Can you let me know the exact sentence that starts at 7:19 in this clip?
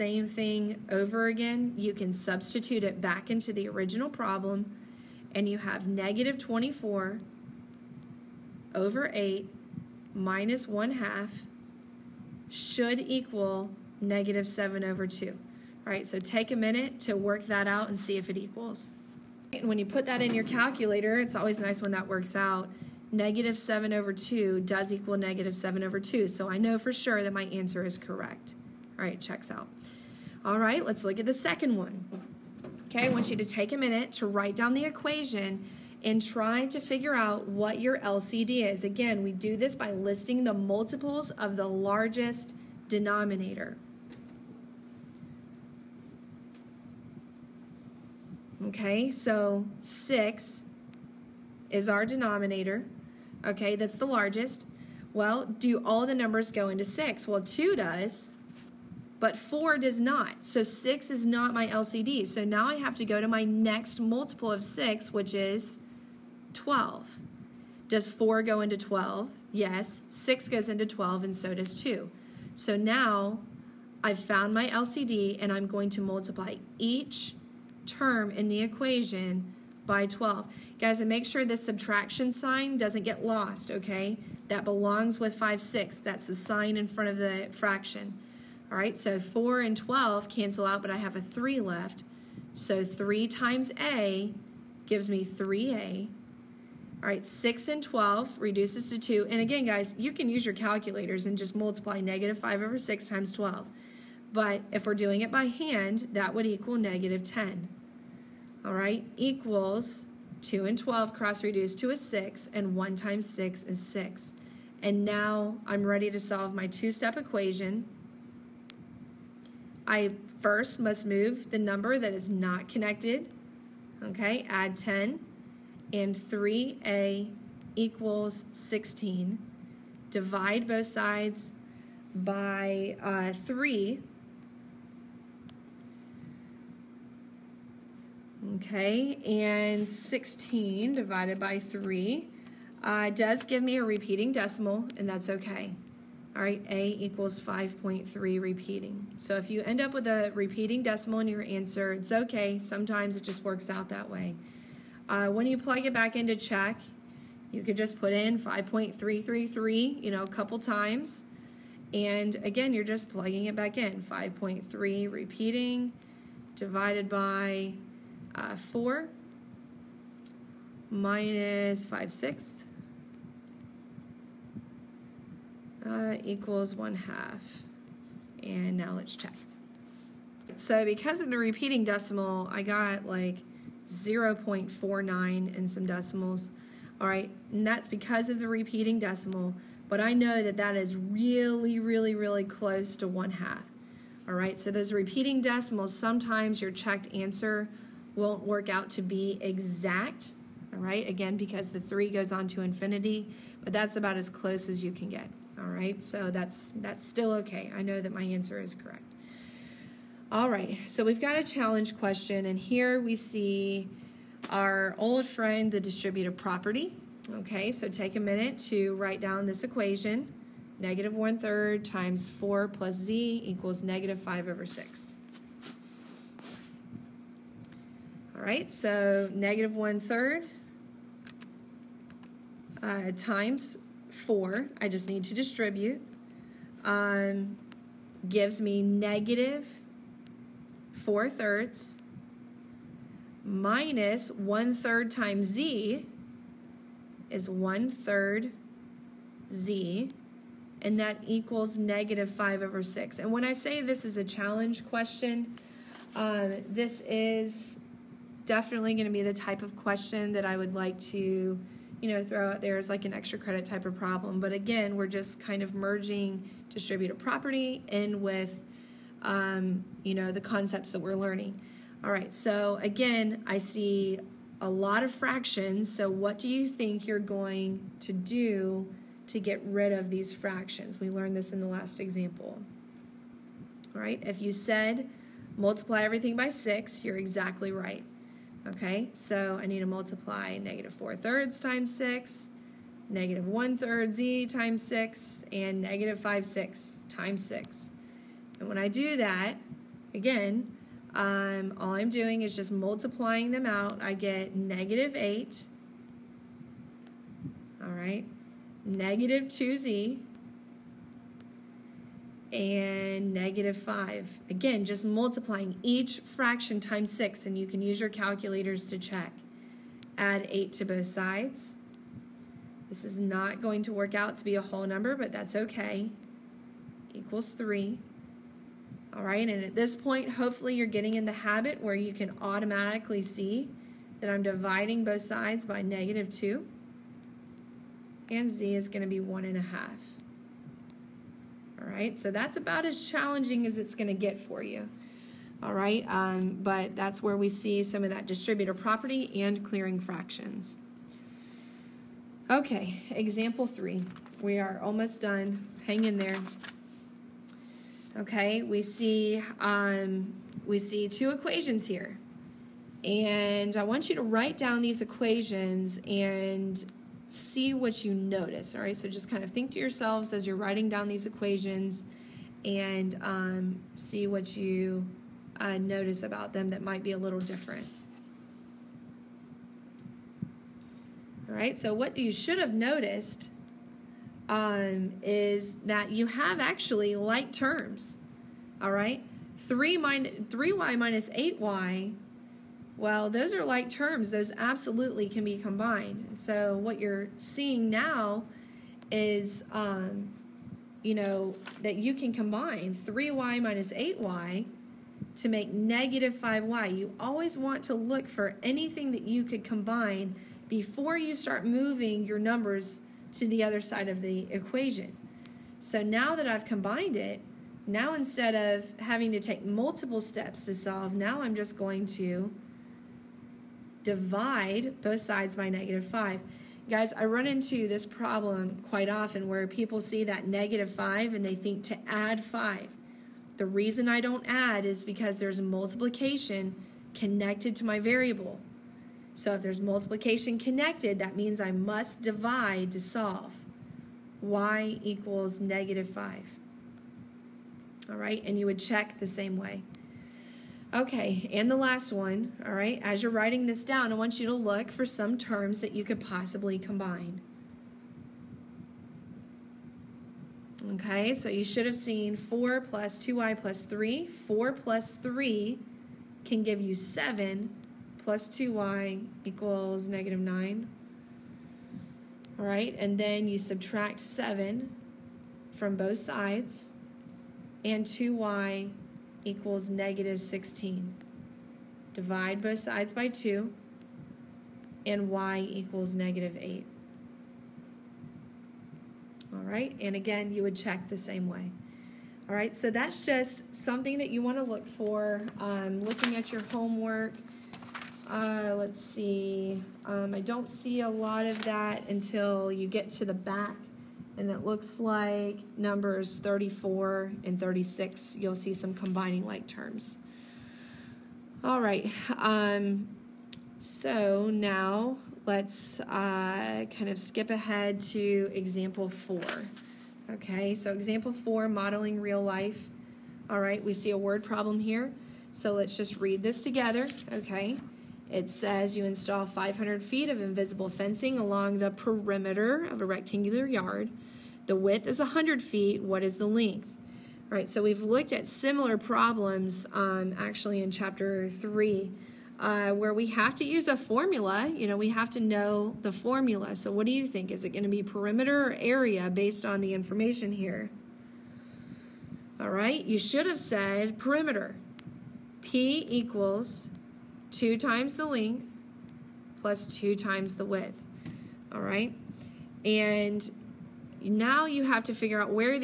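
So if there's multiplication connected, that means I must divide to solve.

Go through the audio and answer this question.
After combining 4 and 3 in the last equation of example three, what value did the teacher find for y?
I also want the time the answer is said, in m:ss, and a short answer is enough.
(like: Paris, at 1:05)
-8, at 8:05.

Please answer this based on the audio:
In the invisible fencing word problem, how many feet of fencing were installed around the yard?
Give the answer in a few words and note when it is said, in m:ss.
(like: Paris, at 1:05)
500 feet, at 8:49.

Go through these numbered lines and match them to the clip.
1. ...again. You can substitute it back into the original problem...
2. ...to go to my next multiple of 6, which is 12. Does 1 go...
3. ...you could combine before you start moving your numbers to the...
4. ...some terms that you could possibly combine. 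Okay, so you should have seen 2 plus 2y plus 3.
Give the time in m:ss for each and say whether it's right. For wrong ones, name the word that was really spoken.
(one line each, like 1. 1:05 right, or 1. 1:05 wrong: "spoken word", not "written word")
1. 0:01 right
2. 1:02 wrong: "4", not "1"
3. 6:49 right
4. 7:35 wrong: "4", not "2".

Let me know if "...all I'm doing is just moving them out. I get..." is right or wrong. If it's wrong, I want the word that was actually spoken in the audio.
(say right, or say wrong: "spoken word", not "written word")
wrong: "multiplying", not "moving".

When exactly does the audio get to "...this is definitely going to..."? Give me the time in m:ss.
4:16.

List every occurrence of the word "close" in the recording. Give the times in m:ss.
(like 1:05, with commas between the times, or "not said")
3:12, 3:24.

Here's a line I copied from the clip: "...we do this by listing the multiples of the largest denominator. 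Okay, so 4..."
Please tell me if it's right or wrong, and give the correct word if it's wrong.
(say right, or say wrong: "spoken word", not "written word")
wrong: "6", not "4".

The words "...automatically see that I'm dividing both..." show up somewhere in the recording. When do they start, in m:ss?
5:32.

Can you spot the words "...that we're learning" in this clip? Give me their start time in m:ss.
4:30.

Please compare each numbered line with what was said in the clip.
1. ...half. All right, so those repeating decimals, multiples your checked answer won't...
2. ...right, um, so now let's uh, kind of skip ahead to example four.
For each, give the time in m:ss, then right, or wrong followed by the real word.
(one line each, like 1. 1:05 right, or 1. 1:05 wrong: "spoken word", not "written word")
1. 3:13 wrong: "sometimes", not "multiples"
2. 8:31 right.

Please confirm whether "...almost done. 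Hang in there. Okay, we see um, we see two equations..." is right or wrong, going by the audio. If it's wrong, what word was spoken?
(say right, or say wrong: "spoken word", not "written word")
right.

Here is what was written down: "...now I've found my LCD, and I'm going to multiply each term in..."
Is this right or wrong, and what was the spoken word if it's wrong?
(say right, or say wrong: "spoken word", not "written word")
right.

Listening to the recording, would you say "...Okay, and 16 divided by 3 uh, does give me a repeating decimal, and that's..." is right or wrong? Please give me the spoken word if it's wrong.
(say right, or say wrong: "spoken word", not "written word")
right.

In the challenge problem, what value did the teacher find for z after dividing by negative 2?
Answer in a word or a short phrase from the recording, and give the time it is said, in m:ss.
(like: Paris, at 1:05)
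1.5, at 5:39.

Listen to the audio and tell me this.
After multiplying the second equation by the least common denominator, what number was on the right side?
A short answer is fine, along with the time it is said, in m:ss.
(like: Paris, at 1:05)
6, at 1:52.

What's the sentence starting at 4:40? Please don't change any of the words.
We learned this in the last example.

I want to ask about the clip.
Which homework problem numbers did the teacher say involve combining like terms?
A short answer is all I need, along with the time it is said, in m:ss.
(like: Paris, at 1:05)
34 and 36, at 8:26.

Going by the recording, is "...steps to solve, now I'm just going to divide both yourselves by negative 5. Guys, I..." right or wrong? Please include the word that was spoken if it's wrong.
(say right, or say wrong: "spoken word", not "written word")
wrong: "sides", not "yourselves".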